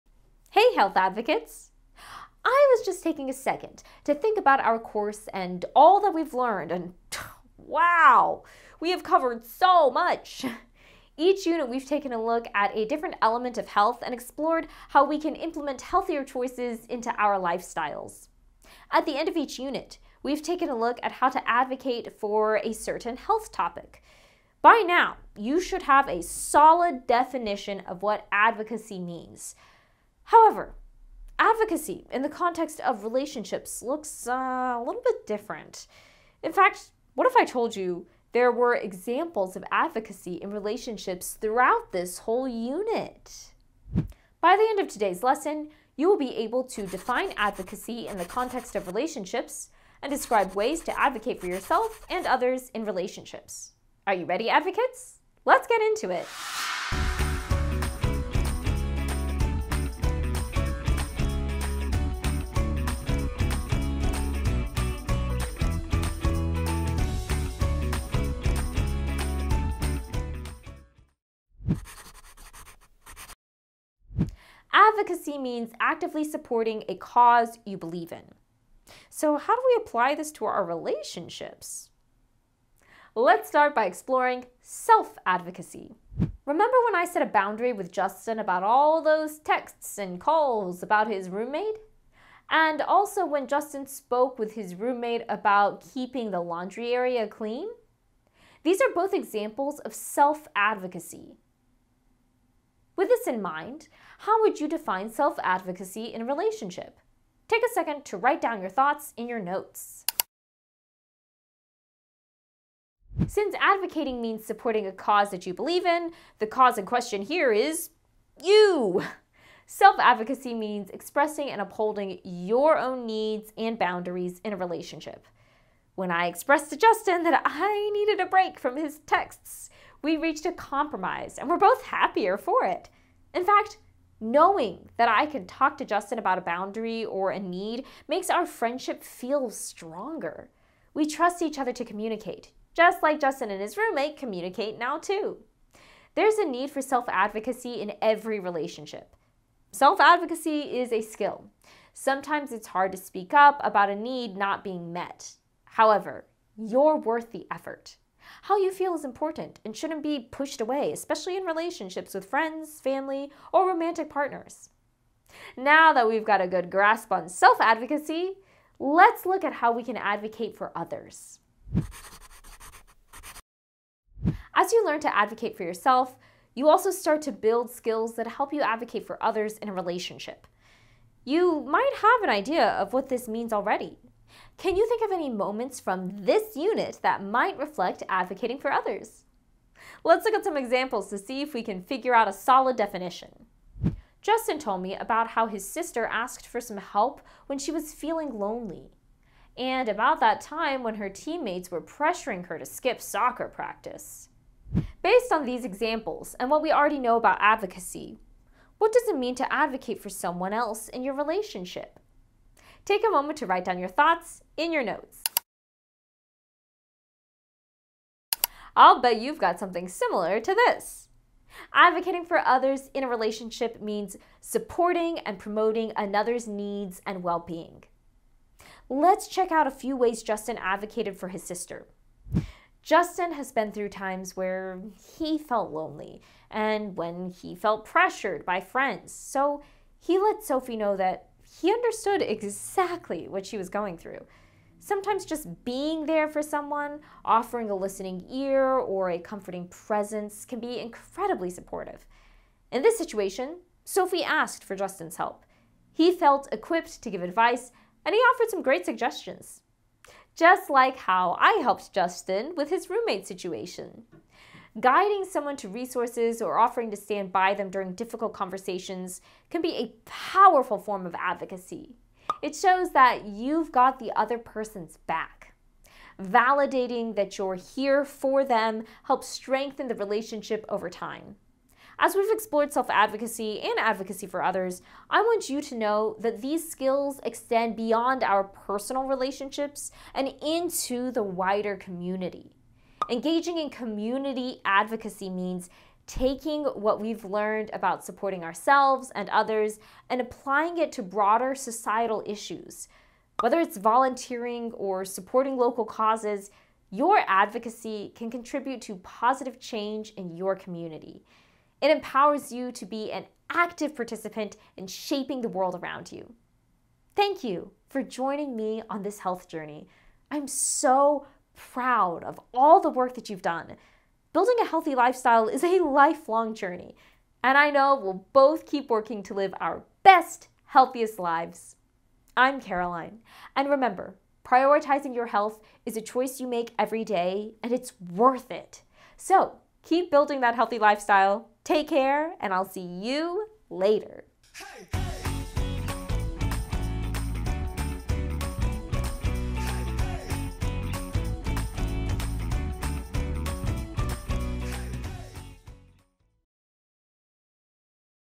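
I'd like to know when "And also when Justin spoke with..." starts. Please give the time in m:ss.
1:32.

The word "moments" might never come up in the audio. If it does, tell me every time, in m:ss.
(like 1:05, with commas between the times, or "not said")
3:05, 3:33.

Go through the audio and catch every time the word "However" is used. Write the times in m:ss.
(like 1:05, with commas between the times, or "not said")
0:30, 2:35.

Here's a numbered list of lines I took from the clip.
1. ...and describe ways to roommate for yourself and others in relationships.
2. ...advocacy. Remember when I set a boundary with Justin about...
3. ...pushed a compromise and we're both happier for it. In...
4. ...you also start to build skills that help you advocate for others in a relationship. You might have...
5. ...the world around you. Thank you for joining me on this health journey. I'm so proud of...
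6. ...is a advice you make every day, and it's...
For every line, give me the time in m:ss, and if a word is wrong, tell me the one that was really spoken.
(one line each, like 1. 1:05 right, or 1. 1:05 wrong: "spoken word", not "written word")
1. 0:50 wrong: "advocate", not "roommate"
2. 1:25 right
3. 2:10 wrong: "reached", not "pushed"
4. 2:56 right
5. 5:15 right
6. 5:35 wrong: "choice", not "advice".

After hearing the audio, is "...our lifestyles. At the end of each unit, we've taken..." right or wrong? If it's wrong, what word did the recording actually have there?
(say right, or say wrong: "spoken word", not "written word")
right.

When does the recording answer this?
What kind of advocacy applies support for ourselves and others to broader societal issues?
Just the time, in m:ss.
4:53.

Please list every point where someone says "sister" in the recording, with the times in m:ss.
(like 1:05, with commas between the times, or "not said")
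3:15, 3:51.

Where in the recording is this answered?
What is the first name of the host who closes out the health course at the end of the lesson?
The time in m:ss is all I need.
5:32.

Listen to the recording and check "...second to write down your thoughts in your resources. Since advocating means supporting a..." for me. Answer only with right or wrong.
wrong.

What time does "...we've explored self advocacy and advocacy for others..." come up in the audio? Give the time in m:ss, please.
4:42.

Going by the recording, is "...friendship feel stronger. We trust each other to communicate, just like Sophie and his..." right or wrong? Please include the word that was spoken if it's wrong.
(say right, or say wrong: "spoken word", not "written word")
wrong: "Justin", not "Sophie".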